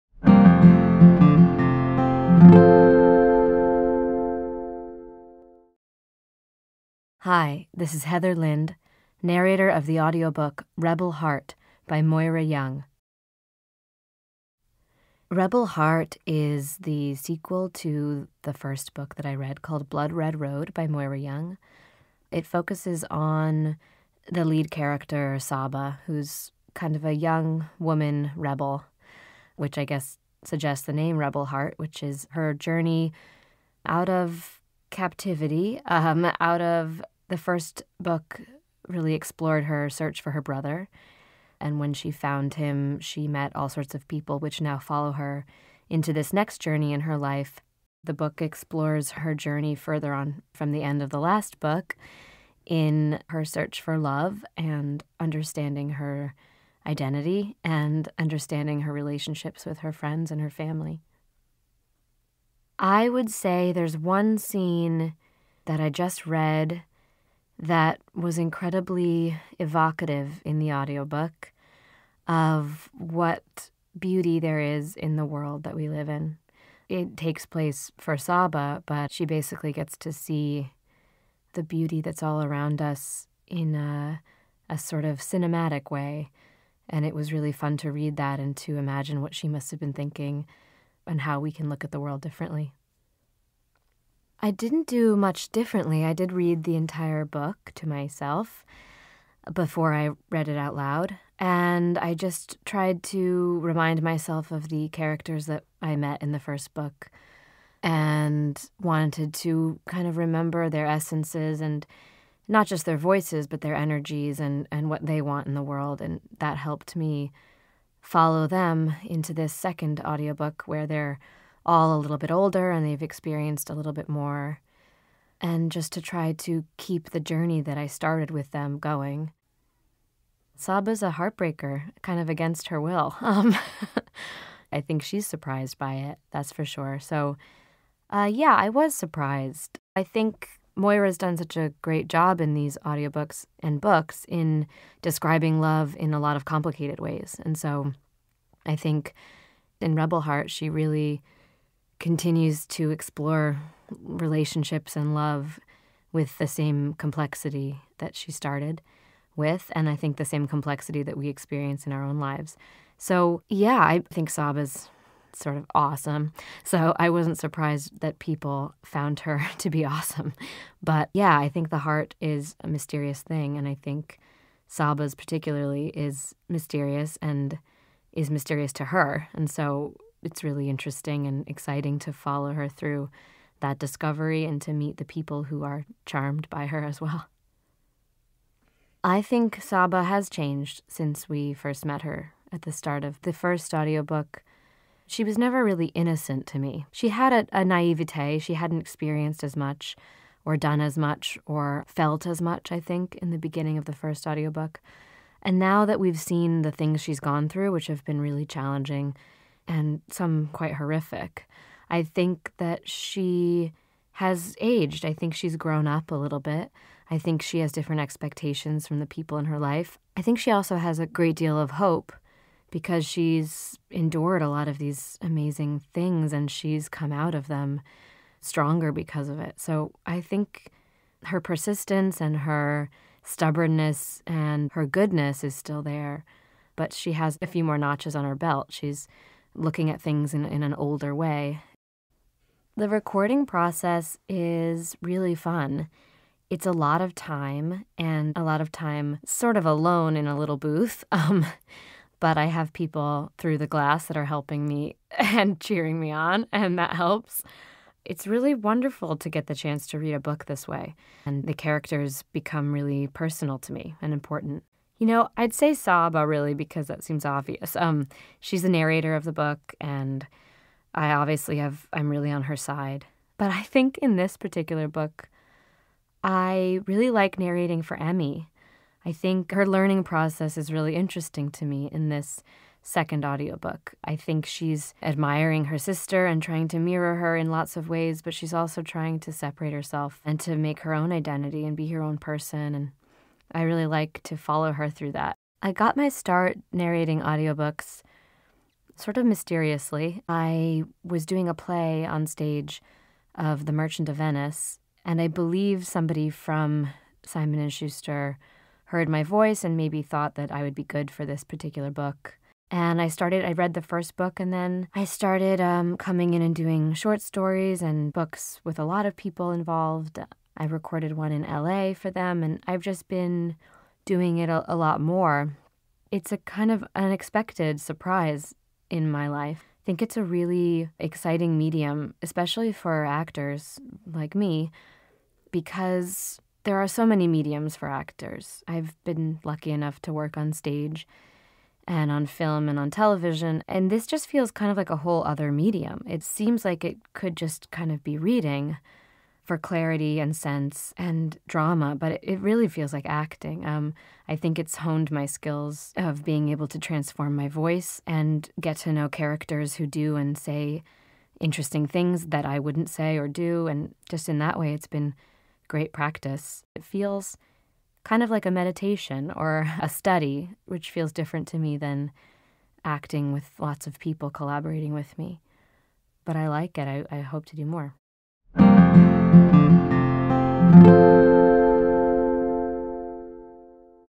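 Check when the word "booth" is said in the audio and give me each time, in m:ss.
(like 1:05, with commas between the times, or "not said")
4:10.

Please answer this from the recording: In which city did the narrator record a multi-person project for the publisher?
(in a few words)
LA.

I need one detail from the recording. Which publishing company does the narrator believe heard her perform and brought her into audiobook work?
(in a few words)
Simon and Schuster.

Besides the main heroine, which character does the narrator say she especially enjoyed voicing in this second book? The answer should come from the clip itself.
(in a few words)
Emmi.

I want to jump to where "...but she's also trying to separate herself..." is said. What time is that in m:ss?
4:48.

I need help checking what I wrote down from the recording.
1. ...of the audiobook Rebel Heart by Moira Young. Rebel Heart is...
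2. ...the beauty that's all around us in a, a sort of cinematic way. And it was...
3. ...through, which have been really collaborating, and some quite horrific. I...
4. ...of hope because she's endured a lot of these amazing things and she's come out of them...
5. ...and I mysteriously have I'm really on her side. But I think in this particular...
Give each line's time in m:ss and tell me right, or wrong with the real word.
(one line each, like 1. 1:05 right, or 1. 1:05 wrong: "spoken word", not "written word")
1. 0:09 right
2. 1:21 right
3. 3:27 wrong: "challenging", not "collaborating"
4. 3:41 right
5. 4:29 wrong: "obviously", not "mysteriously".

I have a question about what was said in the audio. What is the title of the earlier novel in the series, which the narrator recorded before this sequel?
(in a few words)
Blood Red Road.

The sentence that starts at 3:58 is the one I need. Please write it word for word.
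She's looking at things in, in an older way.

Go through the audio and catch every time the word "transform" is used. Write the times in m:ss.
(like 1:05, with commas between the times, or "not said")
5:56.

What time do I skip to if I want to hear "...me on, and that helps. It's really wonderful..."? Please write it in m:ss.
4:15.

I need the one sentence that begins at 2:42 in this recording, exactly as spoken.
So, yeah, I think Saba is sort of awesome.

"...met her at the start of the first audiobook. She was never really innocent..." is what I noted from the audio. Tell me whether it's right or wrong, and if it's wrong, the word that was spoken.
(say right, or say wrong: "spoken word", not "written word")
right.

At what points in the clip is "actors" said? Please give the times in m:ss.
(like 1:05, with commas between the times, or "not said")
5:33, 5:37.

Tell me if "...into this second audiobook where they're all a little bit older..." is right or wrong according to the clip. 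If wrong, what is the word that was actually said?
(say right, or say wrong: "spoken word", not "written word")
right.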